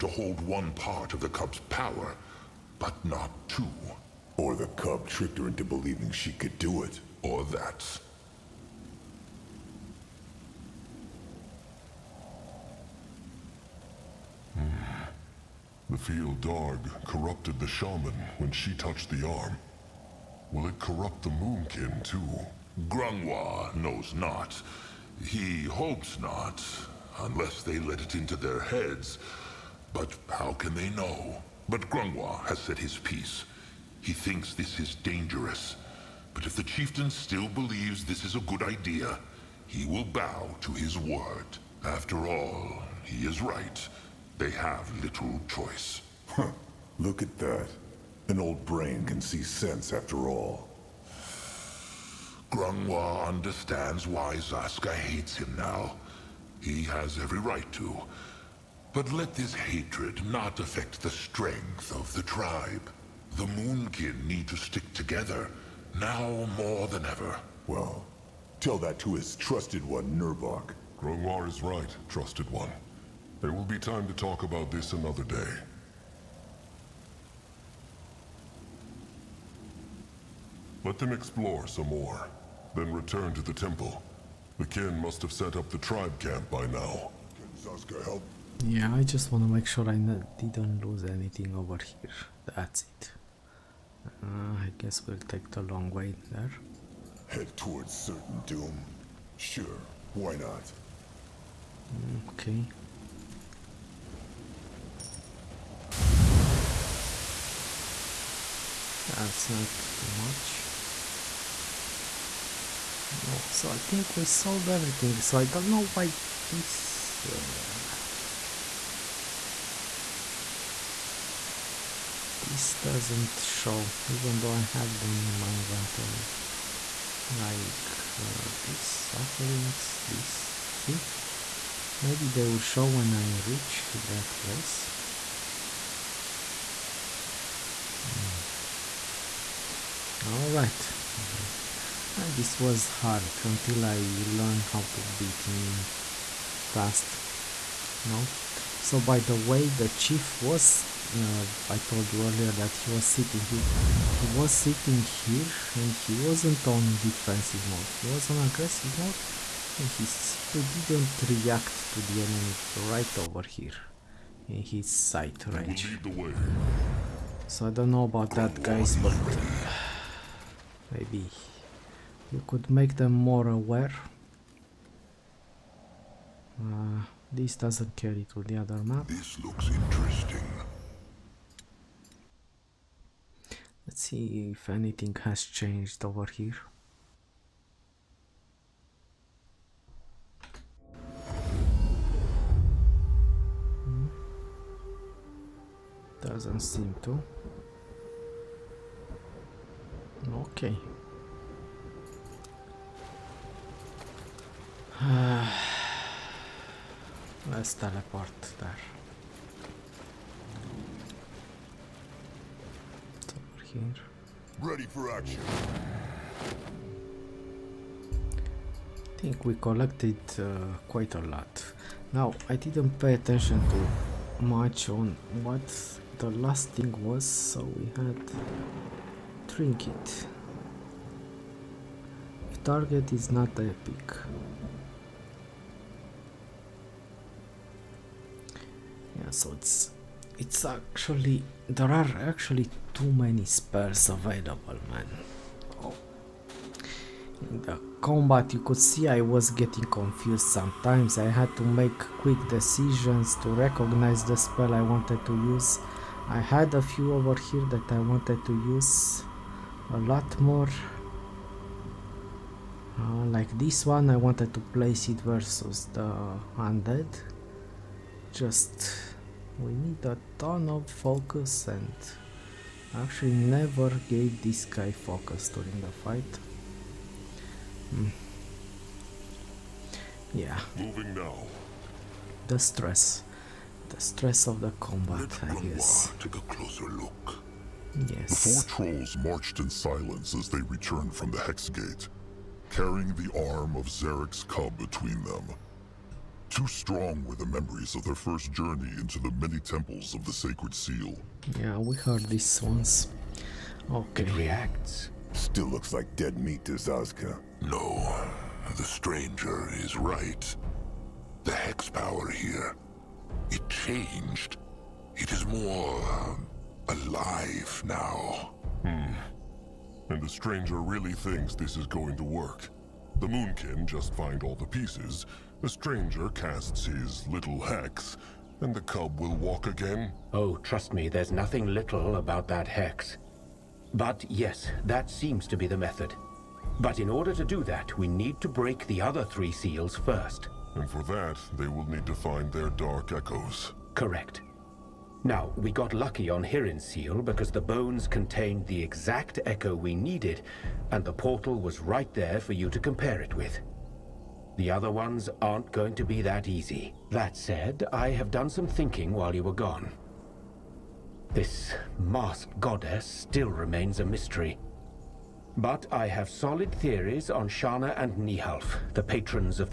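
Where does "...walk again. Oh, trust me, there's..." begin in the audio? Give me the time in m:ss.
5:29.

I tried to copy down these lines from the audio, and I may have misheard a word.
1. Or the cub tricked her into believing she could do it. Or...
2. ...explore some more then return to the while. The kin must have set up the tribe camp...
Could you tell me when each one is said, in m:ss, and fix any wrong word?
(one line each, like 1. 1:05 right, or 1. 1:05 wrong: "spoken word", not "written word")
1. 0:04 right
2. 1:21 wrong: "temple", not "while".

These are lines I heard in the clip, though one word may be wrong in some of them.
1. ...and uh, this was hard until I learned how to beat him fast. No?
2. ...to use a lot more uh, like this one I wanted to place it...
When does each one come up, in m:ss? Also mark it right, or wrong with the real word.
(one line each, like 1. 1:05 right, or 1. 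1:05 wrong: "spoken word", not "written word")
1. 2:22 right
2. 4:18 right.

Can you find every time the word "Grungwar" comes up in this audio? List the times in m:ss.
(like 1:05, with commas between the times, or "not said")
0:22, 0:31, 0:52, 1:11.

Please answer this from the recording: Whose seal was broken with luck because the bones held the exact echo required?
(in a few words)
Hirin.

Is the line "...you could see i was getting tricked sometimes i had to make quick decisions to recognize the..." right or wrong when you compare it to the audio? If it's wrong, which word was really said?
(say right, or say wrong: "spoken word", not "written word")
wrong: "confused", not "tricked".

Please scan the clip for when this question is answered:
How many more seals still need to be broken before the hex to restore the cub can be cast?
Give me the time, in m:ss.
5:39.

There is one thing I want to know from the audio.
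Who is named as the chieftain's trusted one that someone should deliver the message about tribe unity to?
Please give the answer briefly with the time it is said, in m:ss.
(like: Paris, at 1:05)
Nurbok, at 1:10.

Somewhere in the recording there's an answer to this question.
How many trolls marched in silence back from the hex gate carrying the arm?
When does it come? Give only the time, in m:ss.
4:48.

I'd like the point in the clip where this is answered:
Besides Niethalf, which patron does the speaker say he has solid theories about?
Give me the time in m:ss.
6:07.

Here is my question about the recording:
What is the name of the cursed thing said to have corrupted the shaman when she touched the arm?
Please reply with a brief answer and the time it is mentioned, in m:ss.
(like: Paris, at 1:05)
Fial Darg, at 0:15.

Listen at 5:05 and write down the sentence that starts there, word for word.
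Still looks like dead meat to Zazka.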